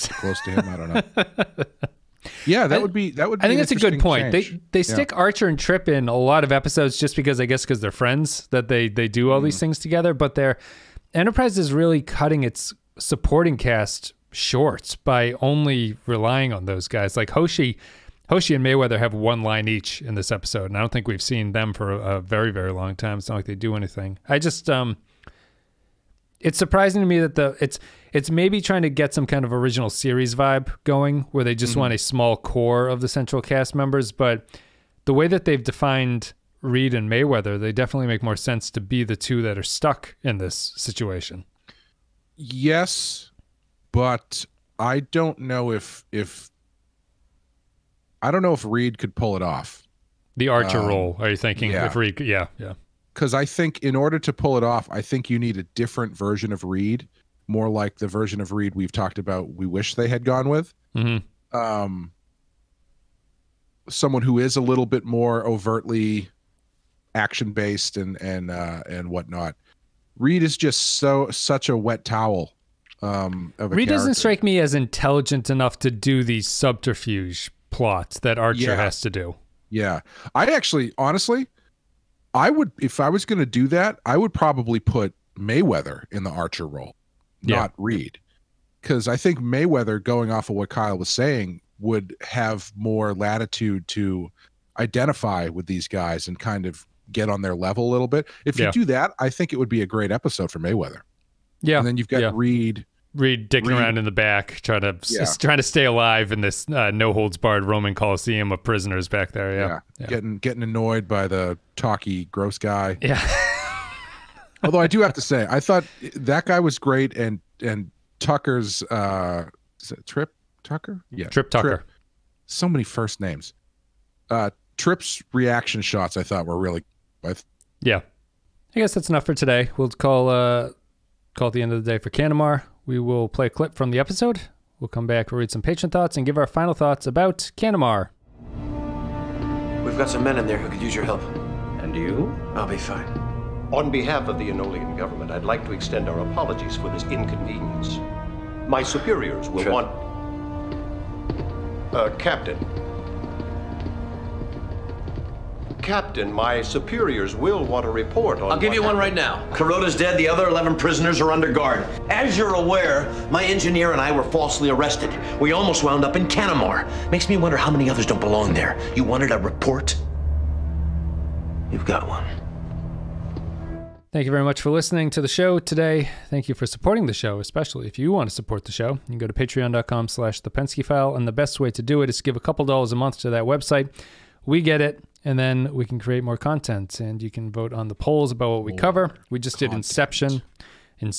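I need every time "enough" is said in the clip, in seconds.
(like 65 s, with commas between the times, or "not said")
75 s, 129 s.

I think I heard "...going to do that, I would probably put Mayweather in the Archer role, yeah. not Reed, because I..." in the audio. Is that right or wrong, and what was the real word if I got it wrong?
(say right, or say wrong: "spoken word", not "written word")
right.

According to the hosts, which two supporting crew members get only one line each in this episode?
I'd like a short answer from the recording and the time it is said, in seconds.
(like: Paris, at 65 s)
Hoshi and Mayweather, at 18 s.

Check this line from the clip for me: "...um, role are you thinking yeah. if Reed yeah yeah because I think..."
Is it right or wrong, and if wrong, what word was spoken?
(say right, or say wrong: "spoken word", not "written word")
right.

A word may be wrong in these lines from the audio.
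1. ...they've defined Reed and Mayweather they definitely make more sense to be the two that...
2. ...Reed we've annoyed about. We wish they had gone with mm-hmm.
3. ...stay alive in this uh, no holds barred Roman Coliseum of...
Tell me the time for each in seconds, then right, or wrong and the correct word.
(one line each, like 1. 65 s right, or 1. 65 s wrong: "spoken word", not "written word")
1. 35 s right
2. 58 s wrong: "talked", not "annoyed"
3. 105 s right.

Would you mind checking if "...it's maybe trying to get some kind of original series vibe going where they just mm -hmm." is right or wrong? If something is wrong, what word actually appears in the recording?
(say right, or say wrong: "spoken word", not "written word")
right.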